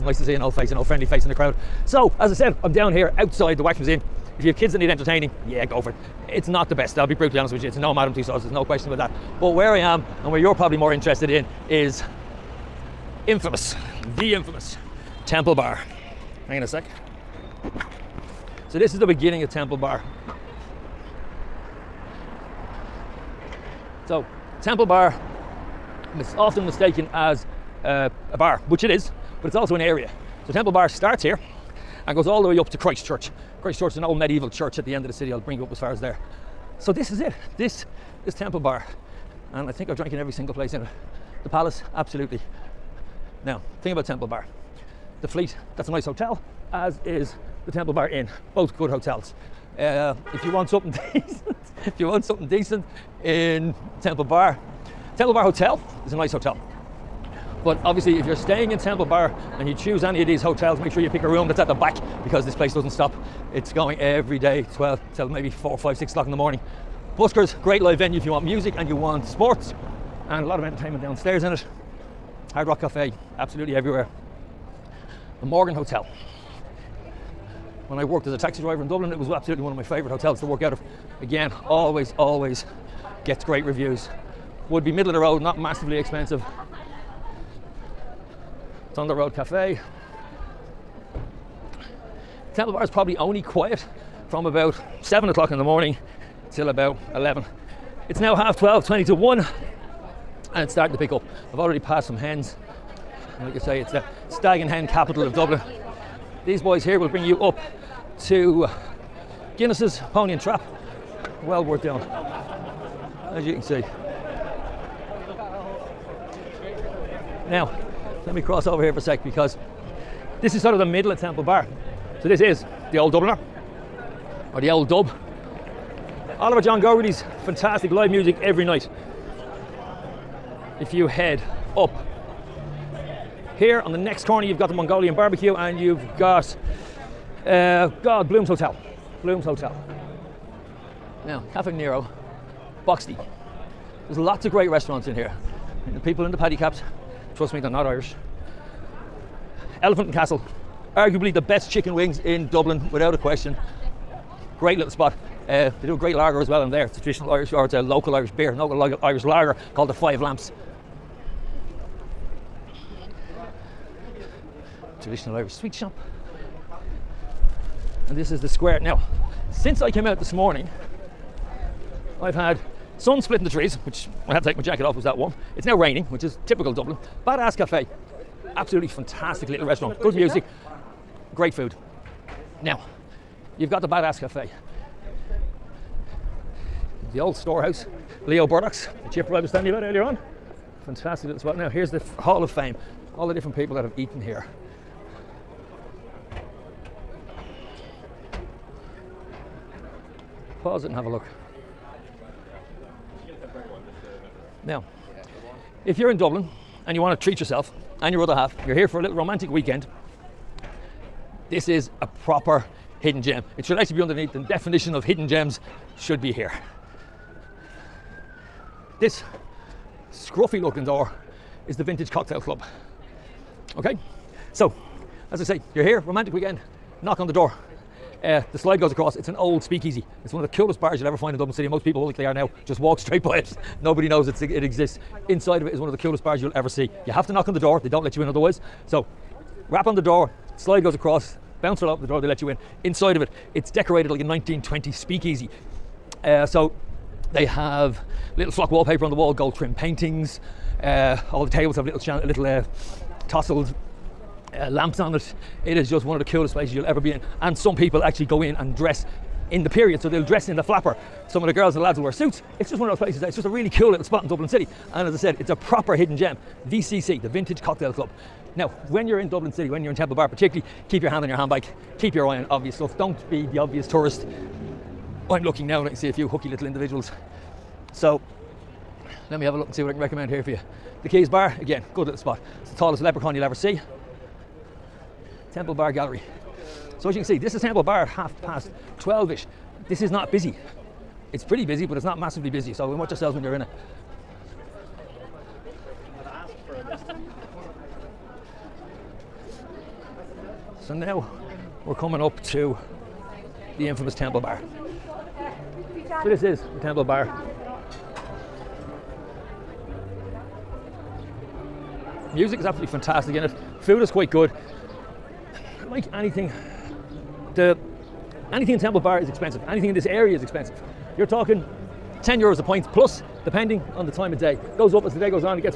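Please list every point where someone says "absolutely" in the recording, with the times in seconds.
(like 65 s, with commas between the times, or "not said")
41 s, 73 s, 79 s, 178 s, 312 s.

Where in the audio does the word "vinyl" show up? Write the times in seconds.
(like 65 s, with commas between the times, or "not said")
not said.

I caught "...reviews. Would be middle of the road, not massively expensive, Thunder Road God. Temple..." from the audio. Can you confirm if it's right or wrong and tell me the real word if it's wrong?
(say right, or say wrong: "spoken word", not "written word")
wrong: "Cafe", not "God".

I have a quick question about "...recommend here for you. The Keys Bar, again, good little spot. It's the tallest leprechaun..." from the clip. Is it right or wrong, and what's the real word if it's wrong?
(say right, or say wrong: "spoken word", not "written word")
right.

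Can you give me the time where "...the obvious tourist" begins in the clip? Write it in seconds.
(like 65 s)
273 s.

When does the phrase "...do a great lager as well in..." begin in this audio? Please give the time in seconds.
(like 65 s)
155 s.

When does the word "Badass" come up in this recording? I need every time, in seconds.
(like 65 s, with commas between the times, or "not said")
177 s, 183 s.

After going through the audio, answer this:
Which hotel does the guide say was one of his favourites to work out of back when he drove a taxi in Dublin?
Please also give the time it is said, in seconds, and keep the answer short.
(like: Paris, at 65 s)
The Morgan Hotel, at 75 s.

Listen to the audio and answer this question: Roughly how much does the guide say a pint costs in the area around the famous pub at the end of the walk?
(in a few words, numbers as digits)
10 euros.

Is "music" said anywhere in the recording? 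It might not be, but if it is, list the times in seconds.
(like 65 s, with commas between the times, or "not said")
68 s, 128 s, 180 s, 312 s.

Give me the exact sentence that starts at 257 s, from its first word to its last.
And some people actually go in and dress in the period, so they'll dress in the flapper.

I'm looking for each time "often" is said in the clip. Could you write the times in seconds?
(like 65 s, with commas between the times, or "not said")
26 s.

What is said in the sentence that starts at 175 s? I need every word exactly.
It's now raining, which is typical Dublin.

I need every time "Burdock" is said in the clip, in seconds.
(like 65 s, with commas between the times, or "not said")
188 s.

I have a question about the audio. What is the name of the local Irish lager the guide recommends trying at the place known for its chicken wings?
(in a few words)
Five Lamps.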